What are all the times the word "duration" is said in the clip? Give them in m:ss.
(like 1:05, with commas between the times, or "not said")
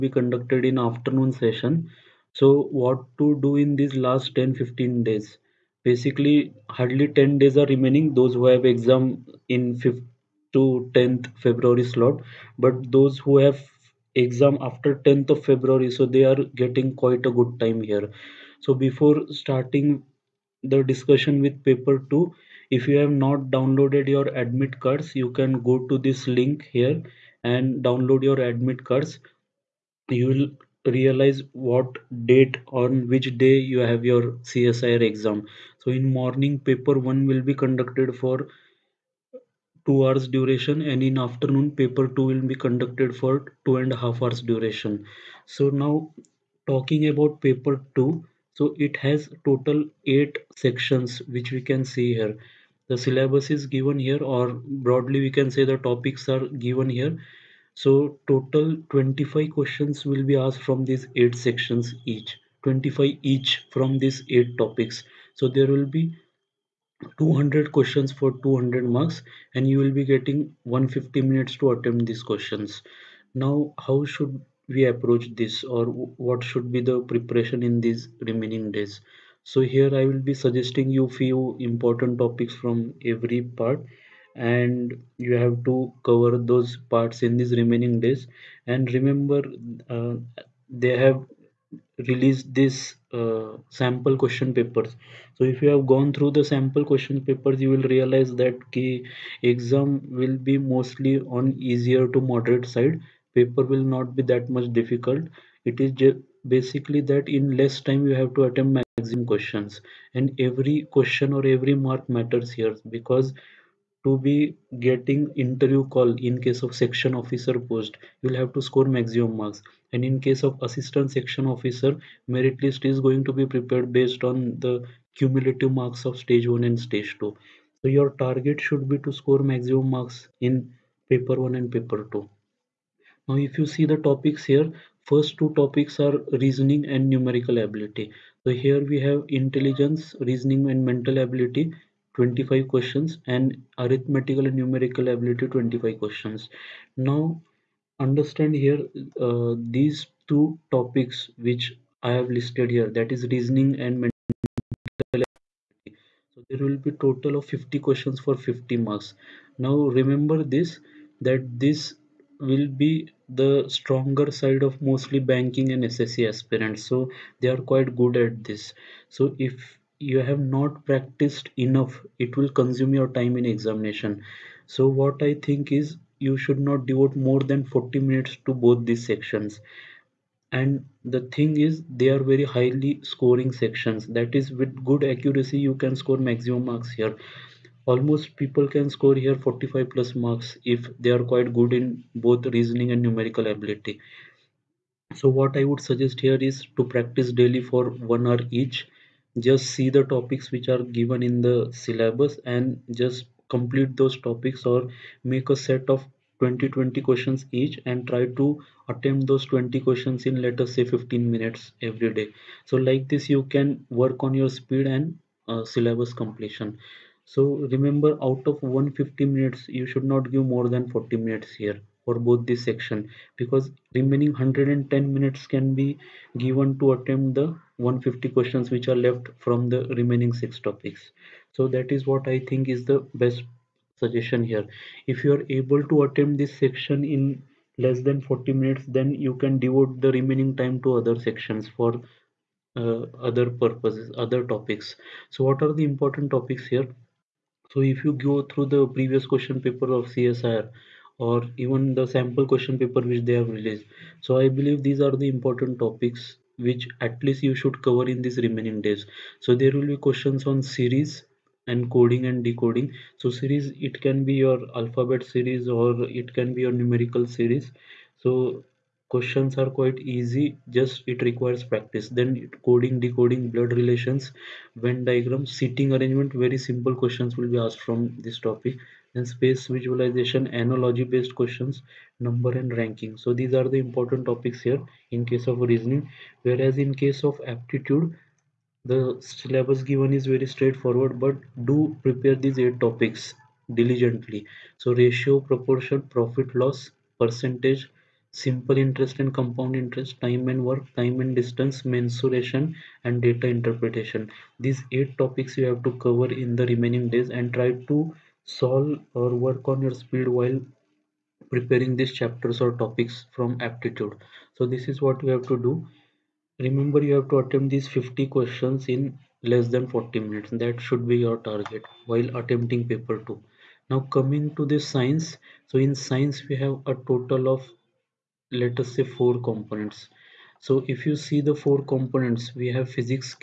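0:40, 0:44.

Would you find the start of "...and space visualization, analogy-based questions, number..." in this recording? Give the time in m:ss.
4:39.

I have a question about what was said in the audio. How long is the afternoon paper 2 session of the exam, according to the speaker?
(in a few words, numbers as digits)
2 and a half hours.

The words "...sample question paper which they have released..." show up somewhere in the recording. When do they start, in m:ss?
4:12.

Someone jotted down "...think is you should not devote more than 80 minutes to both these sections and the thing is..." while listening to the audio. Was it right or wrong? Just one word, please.
wrong.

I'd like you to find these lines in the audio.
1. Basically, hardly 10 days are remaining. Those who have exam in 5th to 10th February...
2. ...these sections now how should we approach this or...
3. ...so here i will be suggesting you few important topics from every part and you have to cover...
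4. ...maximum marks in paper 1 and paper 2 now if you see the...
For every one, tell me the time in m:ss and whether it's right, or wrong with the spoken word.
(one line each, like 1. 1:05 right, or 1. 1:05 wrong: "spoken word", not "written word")
1. 0:05 right
2. 1:12 wrong: "questions", not "sections"
3. 1:19 right
4. 2:09 right.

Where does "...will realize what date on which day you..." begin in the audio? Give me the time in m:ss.
0:30.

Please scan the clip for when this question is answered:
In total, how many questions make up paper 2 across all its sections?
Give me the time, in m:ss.
1:07.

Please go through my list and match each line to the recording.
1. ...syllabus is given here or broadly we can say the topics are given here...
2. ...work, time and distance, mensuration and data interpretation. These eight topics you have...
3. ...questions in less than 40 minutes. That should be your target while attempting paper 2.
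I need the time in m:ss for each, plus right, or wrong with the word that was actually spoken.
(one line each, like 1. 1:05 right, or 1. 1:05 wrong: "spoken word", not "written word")
1. 0:53 right
2. 5:00 right
3. 5:18 right.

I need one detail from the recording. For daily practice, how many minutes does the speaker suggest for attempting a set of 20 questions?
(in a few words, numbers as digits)
15 minutes.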